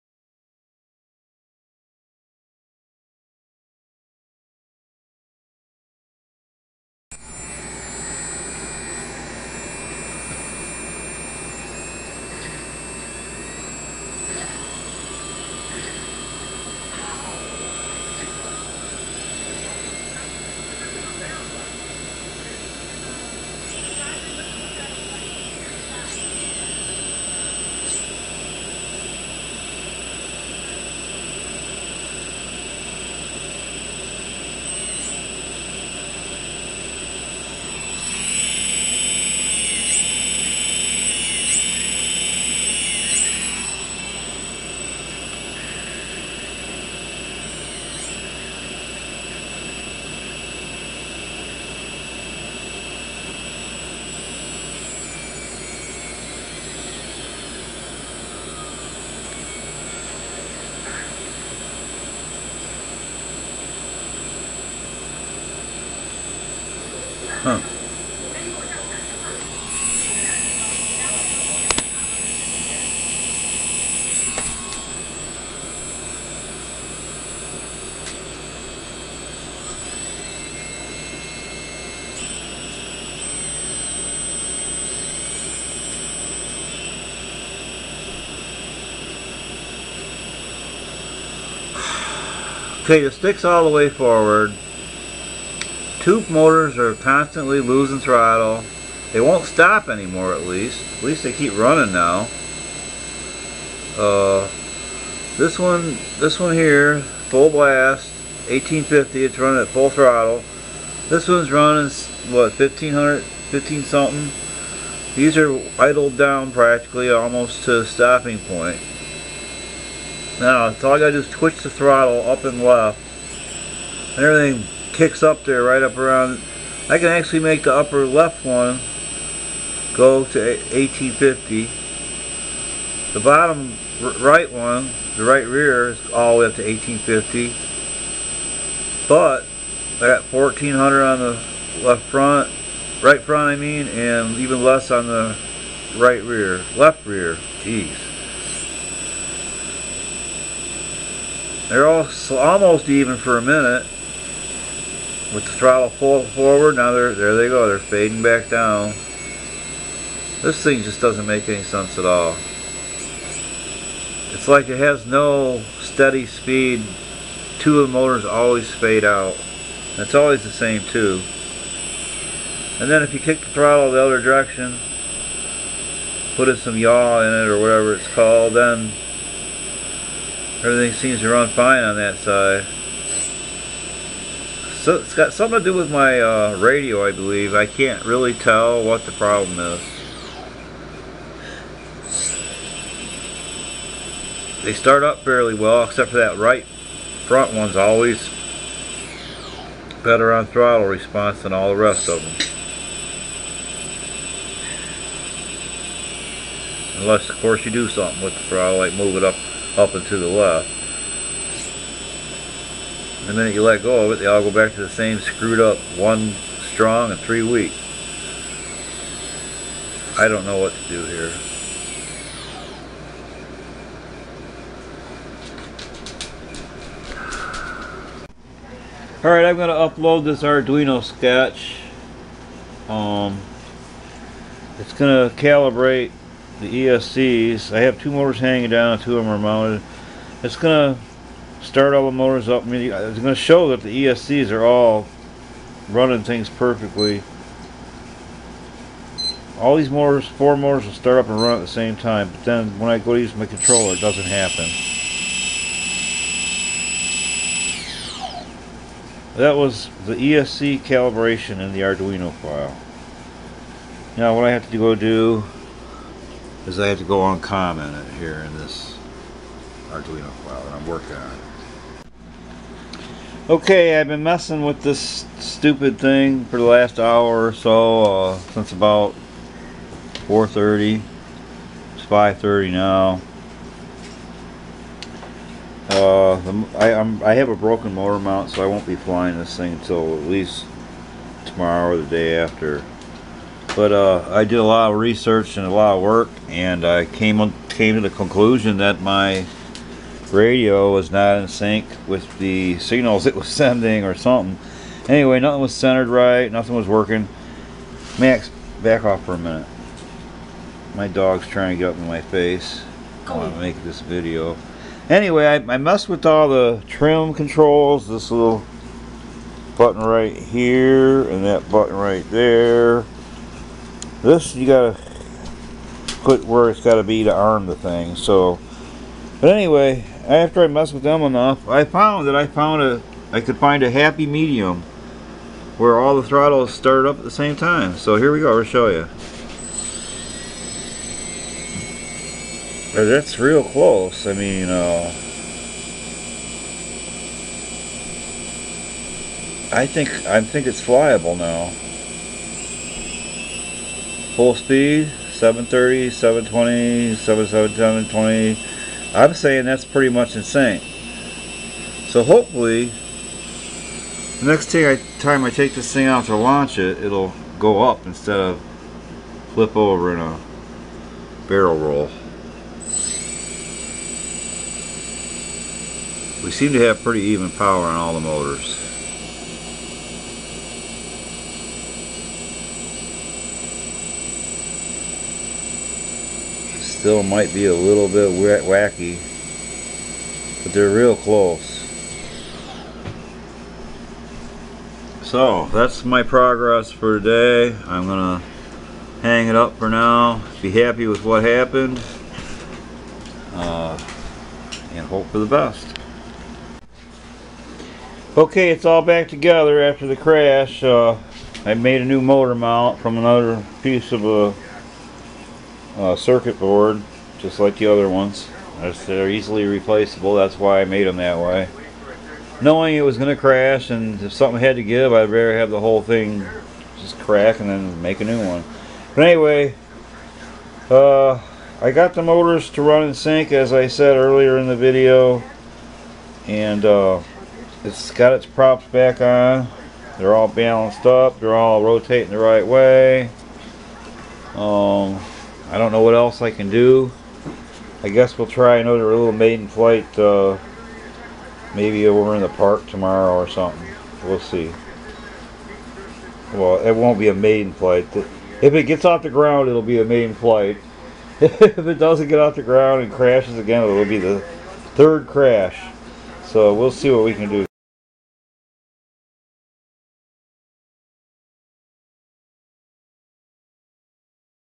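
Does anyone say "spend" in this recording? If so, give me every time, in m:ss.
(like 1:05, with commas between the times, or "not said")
not said.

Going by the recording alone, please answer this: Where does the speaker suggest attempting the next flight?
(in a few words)
the park.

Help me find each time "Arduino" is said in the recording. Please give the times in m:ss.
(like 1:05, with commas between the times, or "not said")
3:50, 4:21, 4:29.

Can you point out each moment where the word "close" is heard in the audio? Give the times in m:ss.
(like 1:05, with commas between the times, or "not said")
5:43, 6:31.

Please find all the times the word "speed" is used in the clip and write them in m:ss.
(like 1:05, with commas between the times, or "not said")
2:46, 5:54.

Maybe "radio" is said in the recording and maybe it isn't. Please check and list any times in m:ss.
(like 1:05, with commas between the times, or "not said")
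3:06, 5:00.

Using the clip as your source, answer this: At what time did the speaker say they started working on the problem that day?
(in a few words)
4:30.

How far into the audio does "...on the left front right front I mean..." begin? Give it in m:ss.
2:21.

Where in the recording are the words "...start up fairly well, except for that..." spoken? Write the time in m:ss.
3:14.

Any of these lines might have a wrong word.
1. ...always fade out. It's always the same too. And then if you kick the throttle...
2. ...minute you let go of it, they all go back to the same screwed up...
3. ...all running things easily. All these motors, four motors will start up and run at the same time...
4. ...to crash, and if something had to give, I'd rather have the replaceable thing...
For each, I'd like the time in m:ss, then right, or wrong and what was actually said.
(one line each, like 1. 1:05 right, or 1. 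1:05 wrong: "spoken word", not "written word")
1. 2:48 right
2. 3:33 right
3. 4:04 wrong: "perfectly", not "easily"
4. 7:03 wrong: "whole", not "replaceable".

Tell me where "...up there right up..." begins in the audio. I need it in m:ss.
2:05.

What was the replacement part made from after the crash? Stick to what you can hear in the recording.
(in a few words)
circuit board.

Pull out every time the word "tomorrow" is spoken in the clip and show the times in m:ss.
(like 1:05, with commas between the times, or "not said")
4:51, 7:32.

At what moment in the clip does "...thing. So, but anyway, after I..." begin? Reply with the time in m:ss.
5:27.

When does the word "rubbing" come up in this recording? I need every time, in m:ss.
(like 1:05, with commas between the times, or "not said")
not said.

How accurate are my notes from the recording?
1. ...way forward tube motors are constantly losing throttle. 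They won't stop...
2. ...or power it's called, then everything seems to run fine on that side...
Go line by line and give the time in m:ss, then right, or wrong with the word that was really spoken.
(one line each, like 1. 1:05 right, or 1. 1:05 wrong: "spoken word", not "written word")
1. 1:33 right
2. 2:57 wrong: "whatever", not "power".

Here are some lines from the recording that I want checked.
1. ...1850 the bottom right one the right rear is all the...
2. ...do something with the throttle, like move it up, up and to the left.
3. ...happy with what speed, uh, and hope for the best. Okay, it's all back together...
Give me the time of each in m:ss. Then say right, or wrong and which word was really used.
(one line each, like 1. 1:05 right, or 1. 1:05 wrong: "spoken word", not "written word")
1. 2:10 right
2. 3:27 right
3. 6:40 wrong: "happened", not "speed".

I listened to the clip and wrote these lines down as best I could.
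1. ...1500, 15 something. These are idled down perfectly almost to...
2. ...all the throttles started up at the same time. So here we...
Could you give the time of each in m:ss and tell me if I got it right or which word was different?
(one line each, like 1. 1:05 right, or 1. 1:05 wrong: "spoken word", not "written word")
1. 1:52 wrong: "practically", not "perfectly"
2. 5:35 right.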